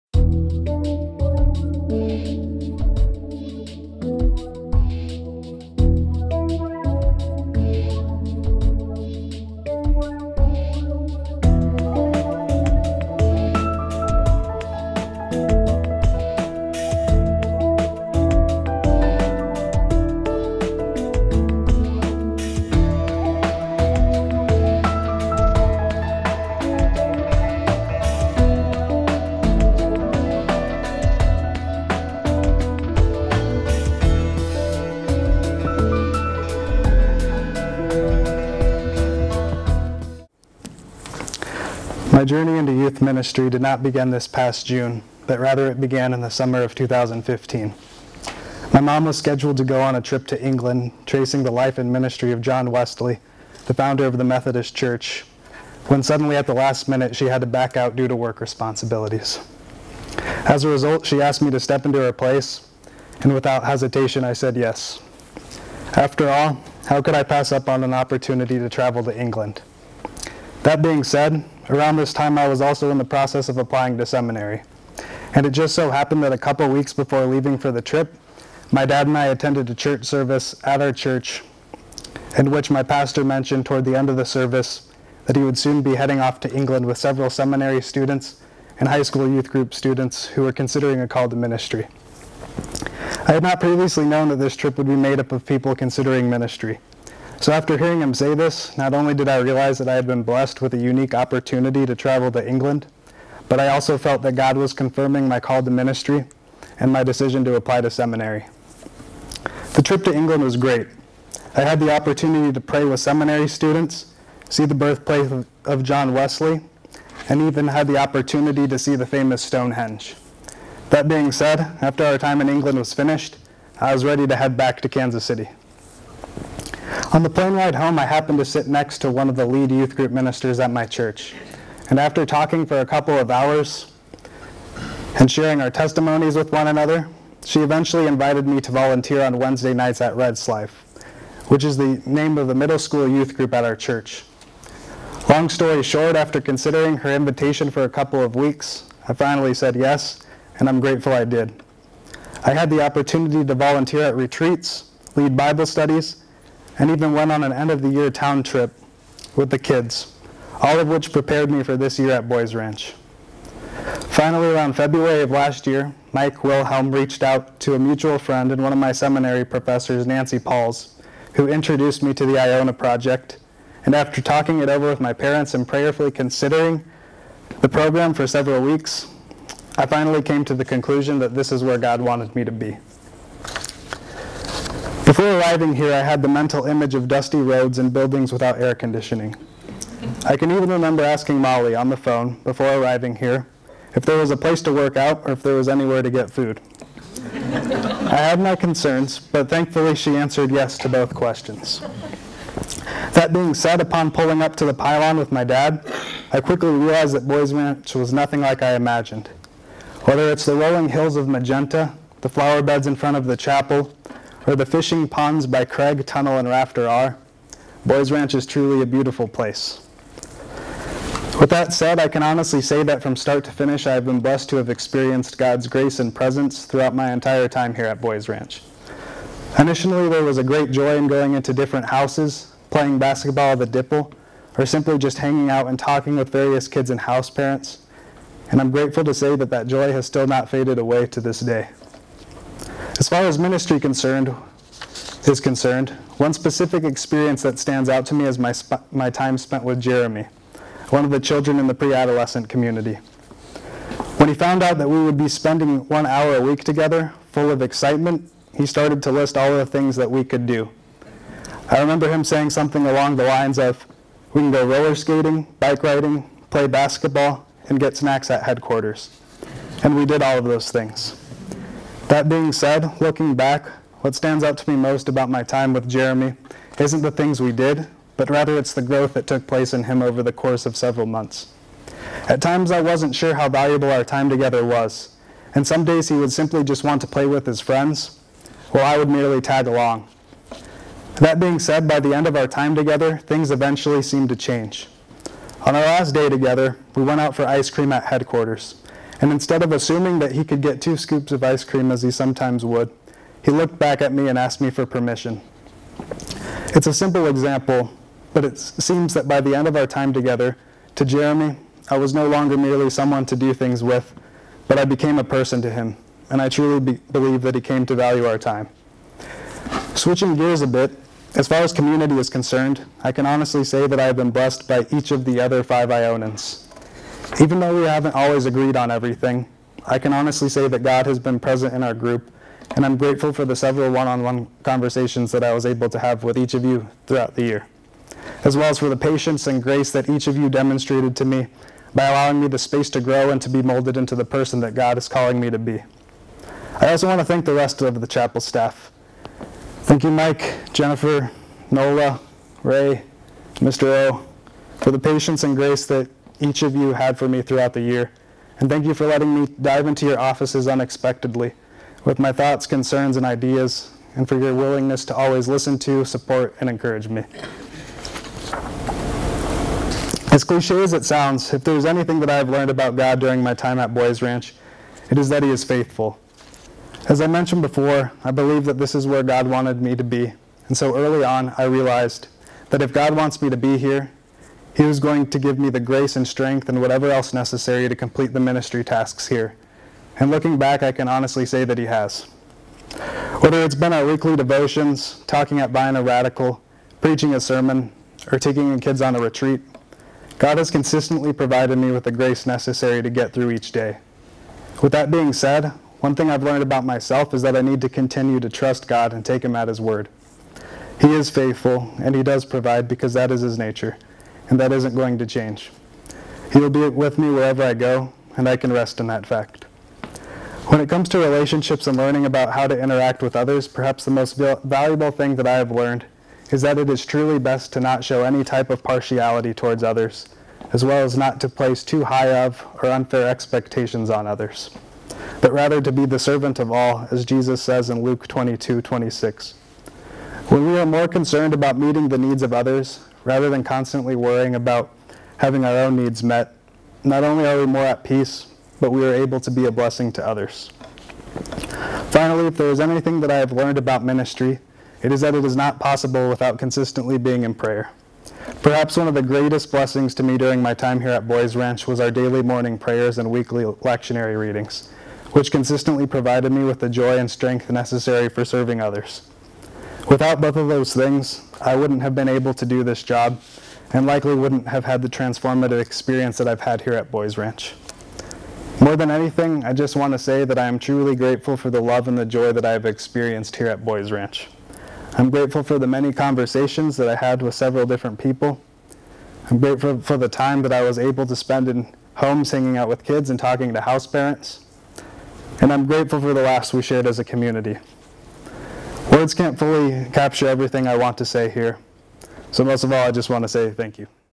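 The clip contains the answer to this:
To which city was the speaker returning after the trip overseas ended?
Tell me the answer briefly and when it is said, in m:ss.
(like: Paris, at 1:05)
Kansas City, at 2:04.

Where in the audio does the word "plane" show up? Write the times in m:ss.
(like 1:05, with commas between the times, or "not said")
2:07.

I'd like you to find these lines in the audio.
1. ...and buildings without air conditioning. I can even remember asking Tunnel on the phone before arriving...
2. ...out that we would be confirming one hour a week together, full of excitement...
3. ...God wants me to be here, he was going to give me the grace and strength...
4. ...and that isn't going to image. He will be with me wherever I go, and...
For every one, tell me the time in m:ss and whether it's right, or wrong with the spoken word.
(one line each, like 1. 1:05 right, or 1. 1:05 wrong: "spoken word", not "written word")
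1. 3:07 wrong: "Molly", not "Tunnel"
2. 4:14 wrong: "spending", not "confirming"
3. 6:22 right
4. 6:54 wrong: "change", not "image".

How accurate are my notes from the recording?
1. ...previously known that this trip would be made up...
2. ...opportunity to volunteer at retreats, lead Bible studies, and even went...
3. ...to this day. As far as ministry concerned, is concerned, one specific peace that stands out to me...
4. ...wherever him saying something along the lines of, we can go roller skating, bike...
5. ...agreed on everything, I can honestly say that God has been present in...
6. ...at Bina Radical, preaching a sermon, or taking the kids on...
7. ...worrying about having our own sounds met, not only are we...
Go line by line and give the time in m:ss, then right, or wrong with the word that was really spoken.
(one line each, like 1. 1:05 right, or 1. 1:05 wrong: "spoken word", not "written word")
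1. 1:33 right
2. 2:32 right
3. 4:01 wrong: "experience", not "peace"
4. 4:21 wrong: "remember", not "wherever"
5. 5:28 right
6. 6:35 right
7. 7:24 wrong: "needs", not "sounds".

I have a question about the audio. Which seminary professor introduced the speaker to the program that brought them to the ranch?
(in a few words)
Nancy Pauls.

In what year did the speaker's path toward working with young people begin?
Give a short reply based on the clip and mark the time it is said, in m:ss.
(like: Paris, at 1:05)
2015, at 0:46.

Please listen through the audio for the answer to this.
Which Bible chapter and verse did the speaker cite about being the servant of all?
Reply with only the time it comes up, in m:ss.
7:18.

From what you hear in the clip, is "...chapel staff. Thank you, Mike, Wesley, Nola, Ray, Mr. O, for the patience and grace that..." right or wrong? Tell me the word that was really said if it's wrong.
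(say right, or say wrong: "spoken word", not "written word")
wrong: "Jennifer", not "Wesley".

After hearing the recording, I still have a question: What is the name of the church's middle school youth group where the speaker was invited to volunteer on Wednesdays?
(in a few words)
Red's Life.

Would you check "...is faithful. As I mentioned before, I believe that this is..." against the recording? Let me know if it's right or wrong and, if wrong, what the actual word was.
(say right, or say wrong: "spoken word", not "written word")
right.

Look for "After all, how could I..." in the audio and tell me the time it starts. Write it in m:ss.
1:05.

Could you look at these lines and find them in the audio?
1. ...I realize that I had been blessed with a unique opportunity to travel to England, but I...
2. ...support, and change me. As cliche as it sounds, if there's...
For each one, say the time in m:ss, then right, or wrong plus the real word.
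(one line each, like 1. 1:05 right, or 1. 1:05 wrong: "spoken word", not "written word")
1. 1:39 right
2. 6:06 wrong: "encourage", not "change".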